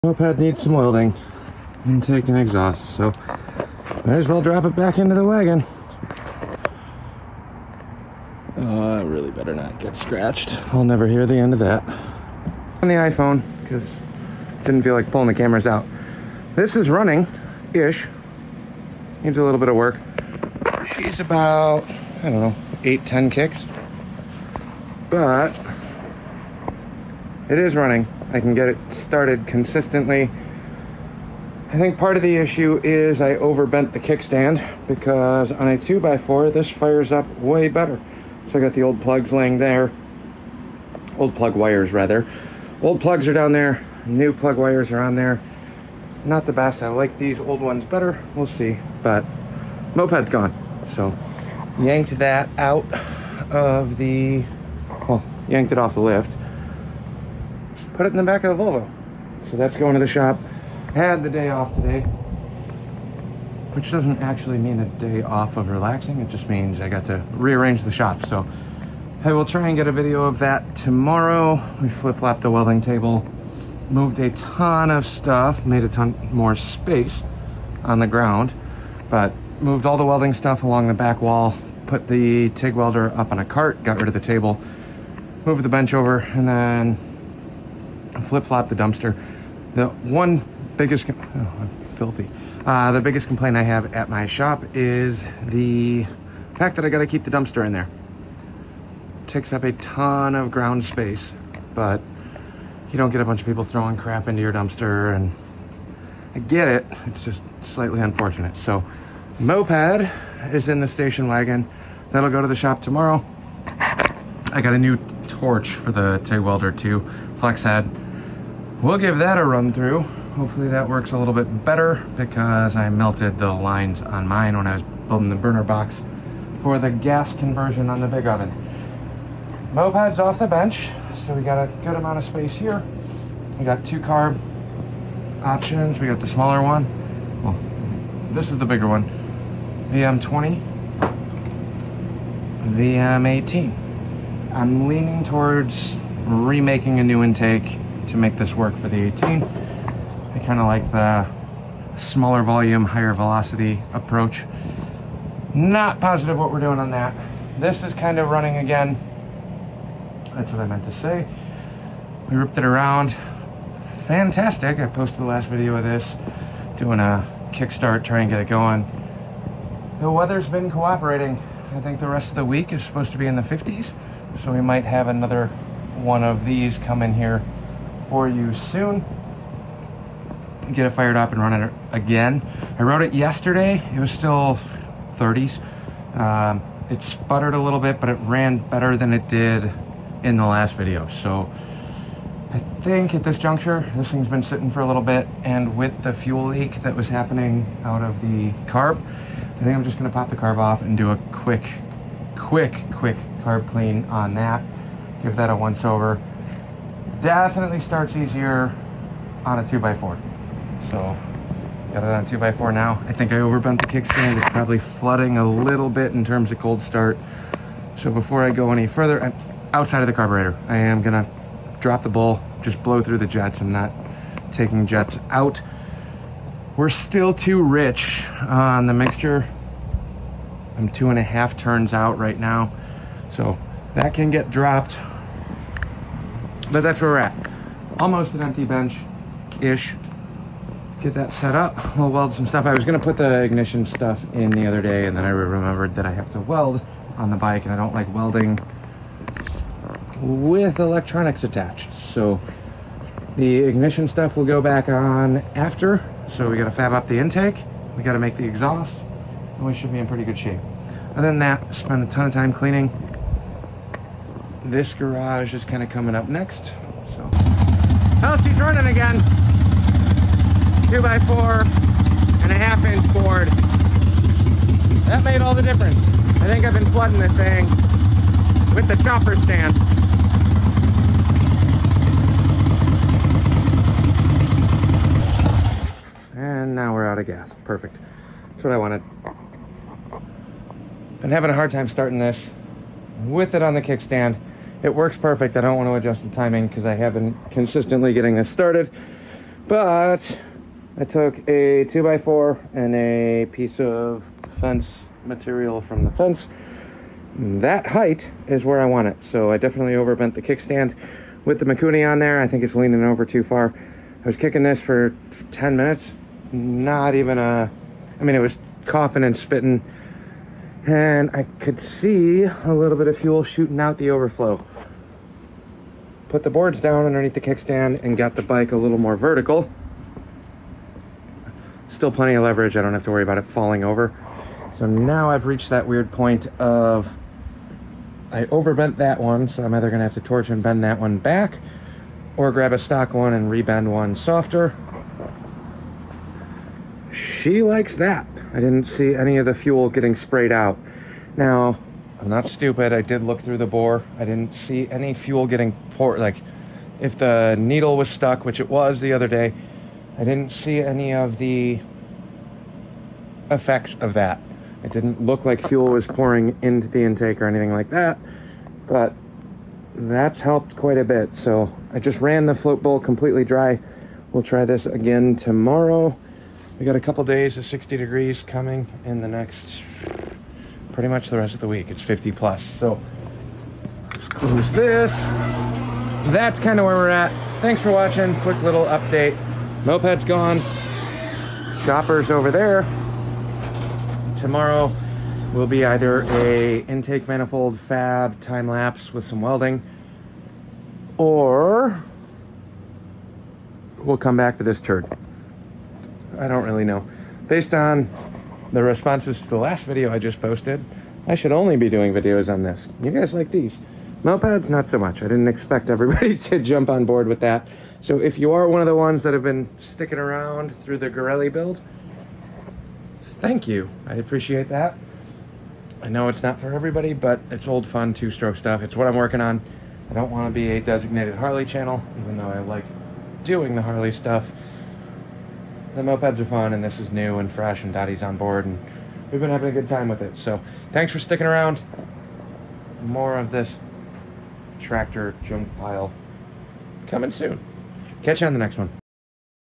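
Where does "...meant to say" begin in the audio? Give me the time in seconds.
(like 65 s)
160 s.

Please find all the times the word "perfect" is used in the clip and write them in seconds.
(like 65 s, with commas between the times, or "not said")
287 s, 295 s.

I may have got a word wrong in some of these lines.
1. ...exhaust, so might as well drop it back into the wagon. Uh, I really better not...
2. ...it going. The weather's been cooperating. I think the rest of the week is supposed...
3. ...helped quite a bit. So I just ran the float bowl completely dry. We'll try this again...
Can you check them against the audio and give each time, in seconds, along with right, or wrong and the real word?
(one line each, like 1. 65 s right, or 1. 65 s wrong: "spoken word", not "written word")
1. 2 s right
2. 168 s right
3. 370 s right.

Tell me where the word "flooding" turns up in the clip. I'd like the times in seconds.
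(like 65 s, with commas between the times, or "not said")
214 s, 276 s.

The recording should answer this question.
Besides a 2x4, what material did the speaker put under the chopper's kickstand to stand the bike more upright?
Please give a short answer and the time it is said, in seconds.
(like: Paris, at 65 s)
fence material, at 304 s.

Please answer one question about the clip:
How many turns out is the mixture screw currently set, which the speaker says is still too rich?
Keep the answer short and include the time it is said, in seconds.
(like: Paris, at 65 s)
2.5, at 230 s.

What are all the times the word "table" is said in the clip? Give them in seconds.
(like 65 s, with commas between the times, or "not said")
72 s, 84 s.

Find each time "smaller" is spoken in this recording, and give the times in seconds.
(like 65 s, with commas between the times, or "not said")
136 s, 151 s.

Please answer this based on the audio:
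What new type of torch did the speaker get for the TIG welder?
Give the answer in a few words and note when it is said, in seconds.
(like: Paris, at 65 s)
flex head, at 117 s.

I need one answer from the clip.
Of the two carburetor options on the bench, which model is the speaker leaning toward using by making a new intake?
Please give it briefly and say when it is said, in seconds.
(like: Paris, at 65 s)
VM18, at 142 s.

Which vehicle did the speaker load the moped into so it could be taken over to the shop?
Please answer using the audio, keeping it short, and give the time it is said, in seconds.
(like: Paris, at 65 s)
Volvo, at 58 s.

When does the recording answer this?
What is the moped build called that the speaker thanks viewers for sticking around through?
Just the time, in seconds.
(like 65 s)
421 s.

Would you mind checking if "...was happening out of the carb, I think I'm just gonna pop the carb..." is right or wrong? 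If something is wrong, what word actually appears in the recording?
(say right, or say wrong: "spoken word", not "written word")
right.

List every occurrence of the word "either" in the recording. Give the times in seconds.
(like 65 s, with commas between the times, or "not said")
339 s, 395 s.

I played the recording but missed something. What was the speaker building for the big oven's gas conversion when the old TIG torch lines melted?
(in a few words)
burner box.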